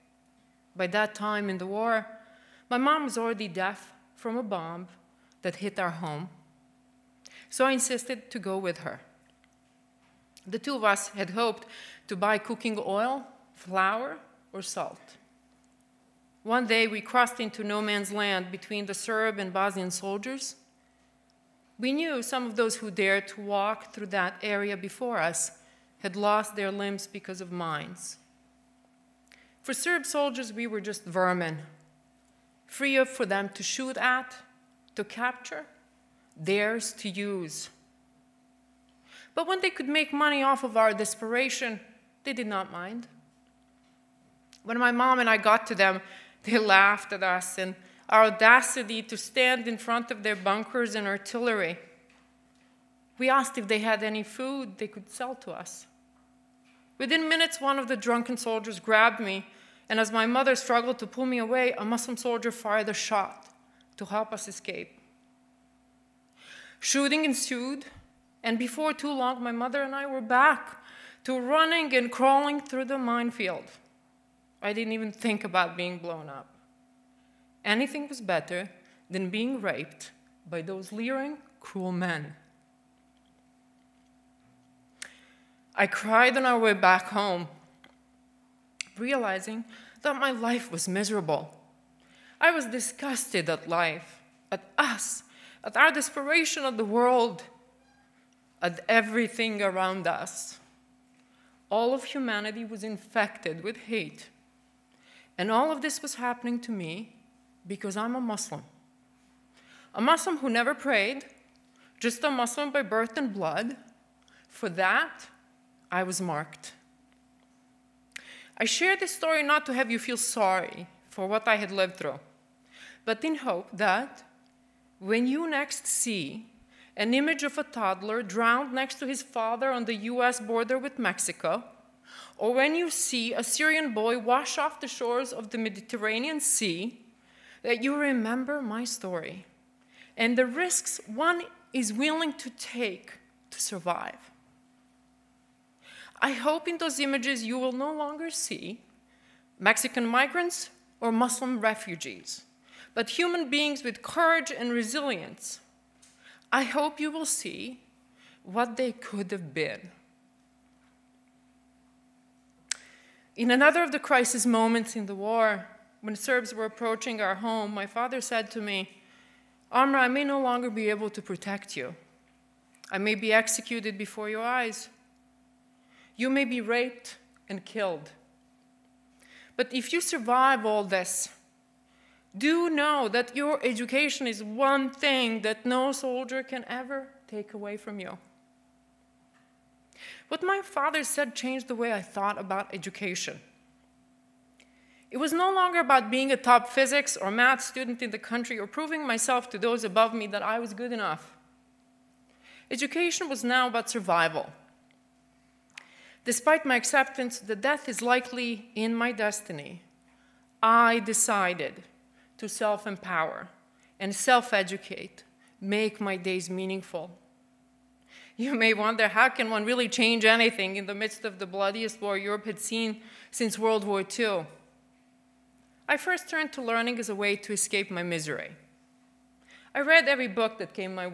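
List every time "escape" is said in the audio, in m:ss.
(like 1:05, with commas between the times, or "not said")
1:04, 3:47.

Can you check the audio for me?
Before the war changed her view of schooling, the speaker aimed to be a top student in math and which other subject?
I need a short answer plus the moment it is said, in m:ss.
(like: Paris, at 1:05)
Physics, at 3:16.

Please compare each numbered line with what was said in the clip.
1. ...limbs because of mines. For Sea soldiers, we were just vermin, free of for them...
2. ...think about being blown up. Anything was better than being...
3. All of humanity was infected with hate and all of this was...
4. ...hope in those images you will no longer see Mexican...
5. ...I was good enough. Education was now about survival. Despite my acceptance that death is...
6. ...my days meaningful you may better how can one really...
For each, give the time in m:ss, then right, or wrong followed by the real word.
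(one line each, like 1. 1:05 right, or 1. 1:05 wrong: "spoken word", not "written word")
1. 0:26 wrong: "Serb", not "Sea"
2. 1:15 right
3. 1:41 right
4. 2:26 right
5. 3:20 right
6. 3:36 wrong: "wonder", not "better".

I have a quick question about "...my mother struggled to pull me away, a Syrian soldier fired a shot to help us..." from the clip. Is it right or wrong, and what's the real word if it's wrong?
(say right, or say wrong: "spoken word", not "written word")
wrong: "Muslim", not "Syrian".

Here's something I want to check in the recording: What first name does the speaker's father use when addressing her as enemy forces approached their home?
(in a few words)
Amra.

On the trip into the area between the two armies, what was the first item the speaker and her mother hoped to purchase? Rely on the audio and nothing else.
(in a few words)
Cooking oil.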